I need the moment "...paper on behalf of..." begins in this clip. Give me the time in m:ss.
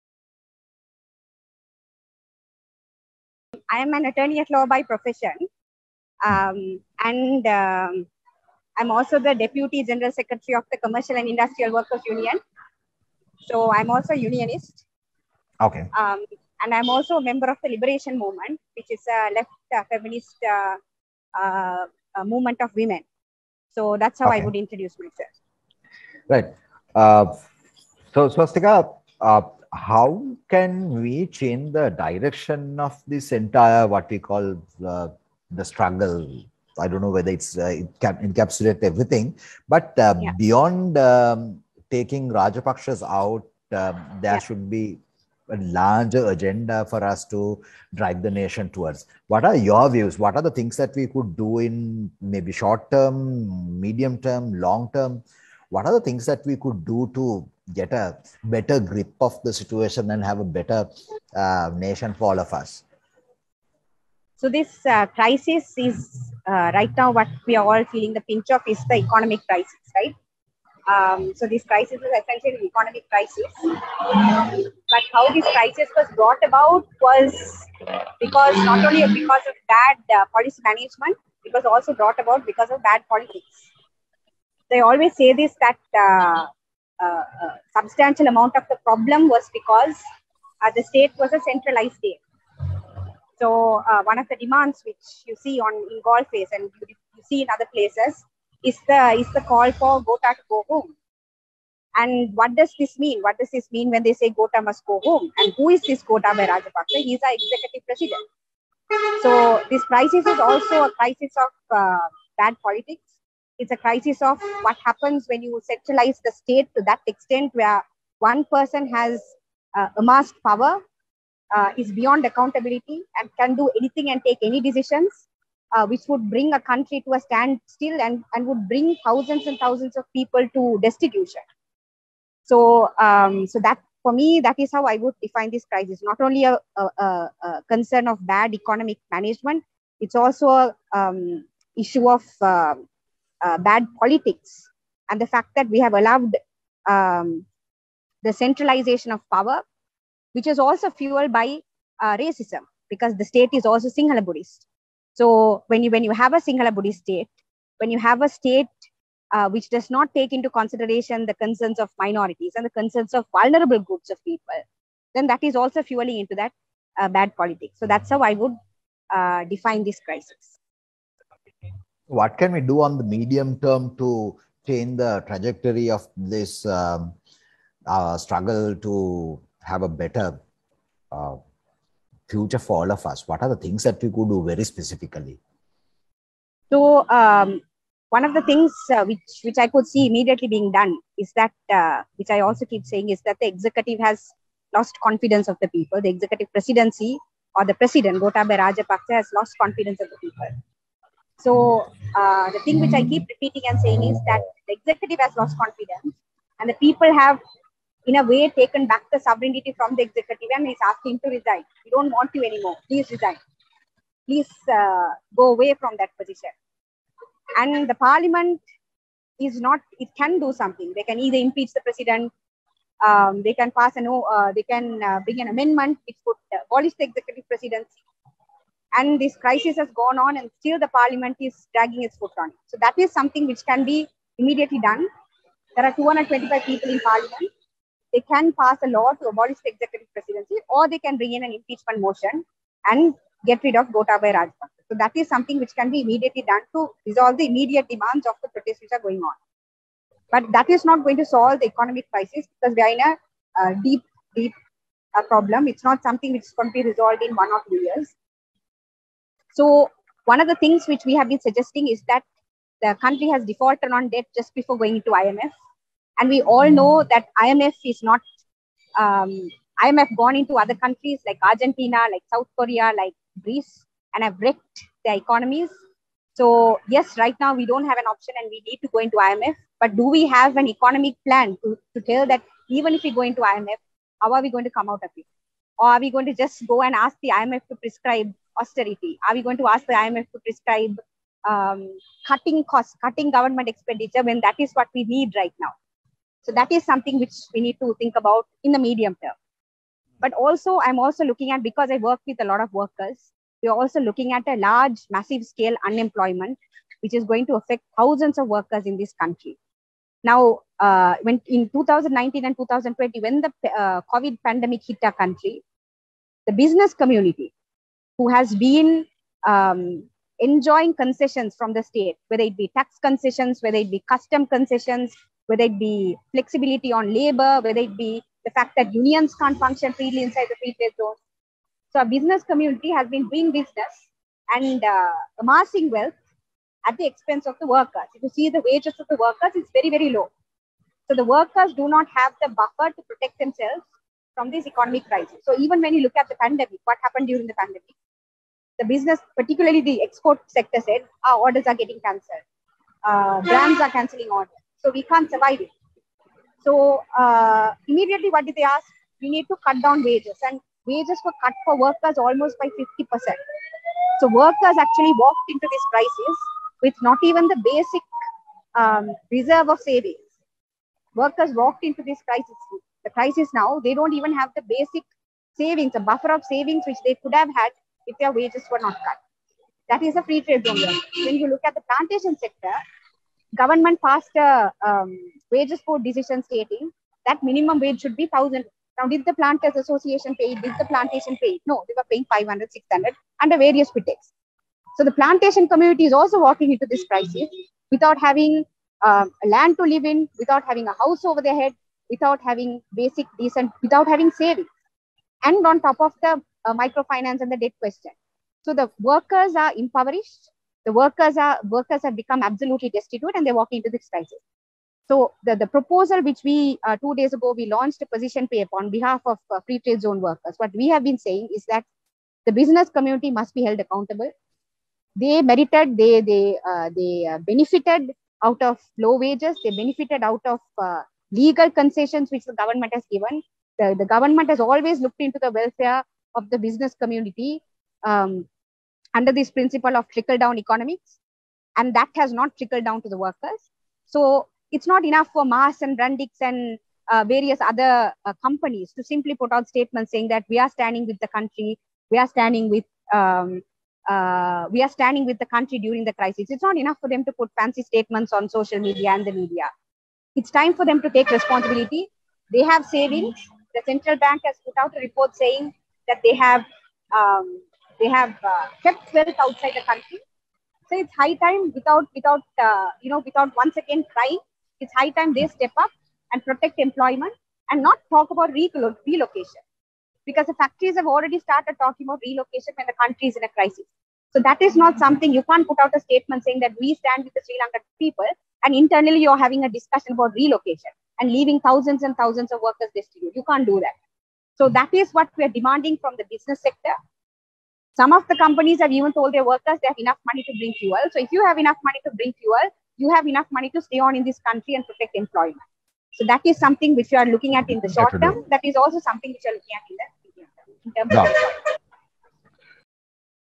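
6:58.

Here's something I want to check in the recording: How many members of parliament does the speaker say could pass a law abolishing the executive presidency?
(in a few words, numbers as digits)
225.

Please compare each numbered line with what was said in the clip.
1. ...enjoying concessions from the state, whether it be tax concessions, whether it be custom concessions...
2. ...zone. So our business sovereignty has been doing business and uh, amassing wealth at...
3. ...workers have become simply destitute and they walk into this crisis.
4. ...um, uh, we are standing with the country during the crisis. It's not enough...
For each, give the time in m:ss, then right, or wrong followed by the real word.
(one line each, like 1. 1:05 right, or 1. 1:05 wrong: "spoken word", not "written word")
1. 5:20 right
2. 5:30 wrong: "community", not "sovereignty"
3. 6:51 wrong: "absolutely", not "simply"
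4. 7:33 right.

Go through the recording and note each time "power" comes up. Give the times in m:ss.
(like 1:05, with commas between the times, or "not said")
2:00, 2:29.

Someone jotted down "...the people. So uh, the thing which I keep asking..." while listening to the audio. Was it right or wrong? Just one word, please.
wrong.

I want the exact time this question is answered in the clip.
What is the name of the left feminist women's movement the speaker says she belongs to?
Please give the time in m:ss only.
0:17.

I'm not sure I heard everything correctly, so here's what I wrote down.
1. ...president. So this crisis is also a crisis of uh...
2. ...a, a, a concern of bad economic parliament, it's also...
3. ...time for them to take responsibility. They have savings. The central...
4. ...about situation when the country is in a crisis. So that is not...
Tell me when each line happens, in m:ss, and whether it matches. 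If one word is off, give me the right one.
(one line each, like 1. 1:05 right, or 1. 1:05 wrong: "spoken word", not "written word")
1. 1:47 right
2. 2:16 wrong: "management", not "parliament"
3. 7:40 right
4. 8:02 wrong: "relocation", not "situation".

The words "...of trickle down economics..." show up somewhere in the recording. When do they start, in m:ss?
7:19.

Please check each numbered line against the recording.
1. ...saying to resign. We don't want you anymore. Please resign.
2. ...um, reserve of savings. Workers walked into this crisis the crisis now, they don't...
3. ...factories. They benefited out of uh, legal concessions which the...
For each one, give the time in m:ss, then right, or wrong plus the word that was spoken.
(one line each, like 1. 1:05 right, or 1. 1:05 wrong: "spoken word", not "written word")
1. 3:30 wrong: "asking", not "saying"
2. 6:08 right
3. 7:09 wrong: "wages", not "factories".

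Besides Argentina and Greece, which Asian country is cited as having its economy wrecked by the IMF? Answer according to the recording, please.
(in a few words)
South Korea.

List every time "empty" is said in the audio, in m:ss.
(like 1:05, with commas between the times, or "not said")
not said.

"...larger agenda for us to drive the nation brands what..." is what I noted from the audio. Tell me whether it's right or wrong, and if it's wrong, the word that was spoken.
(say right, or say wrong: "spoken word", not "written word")
wrong: "towards", not "brands".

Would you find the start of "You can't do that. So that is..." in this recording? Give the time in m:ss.
8:13.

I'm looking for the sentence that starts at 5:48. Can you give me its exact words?
The business, particularly the export sector, said our orders are getting cancelled.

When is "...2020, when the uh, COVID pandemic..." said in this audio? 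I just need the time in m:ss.
5:12.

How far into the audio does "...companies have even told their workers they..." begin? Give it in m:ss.
8:18.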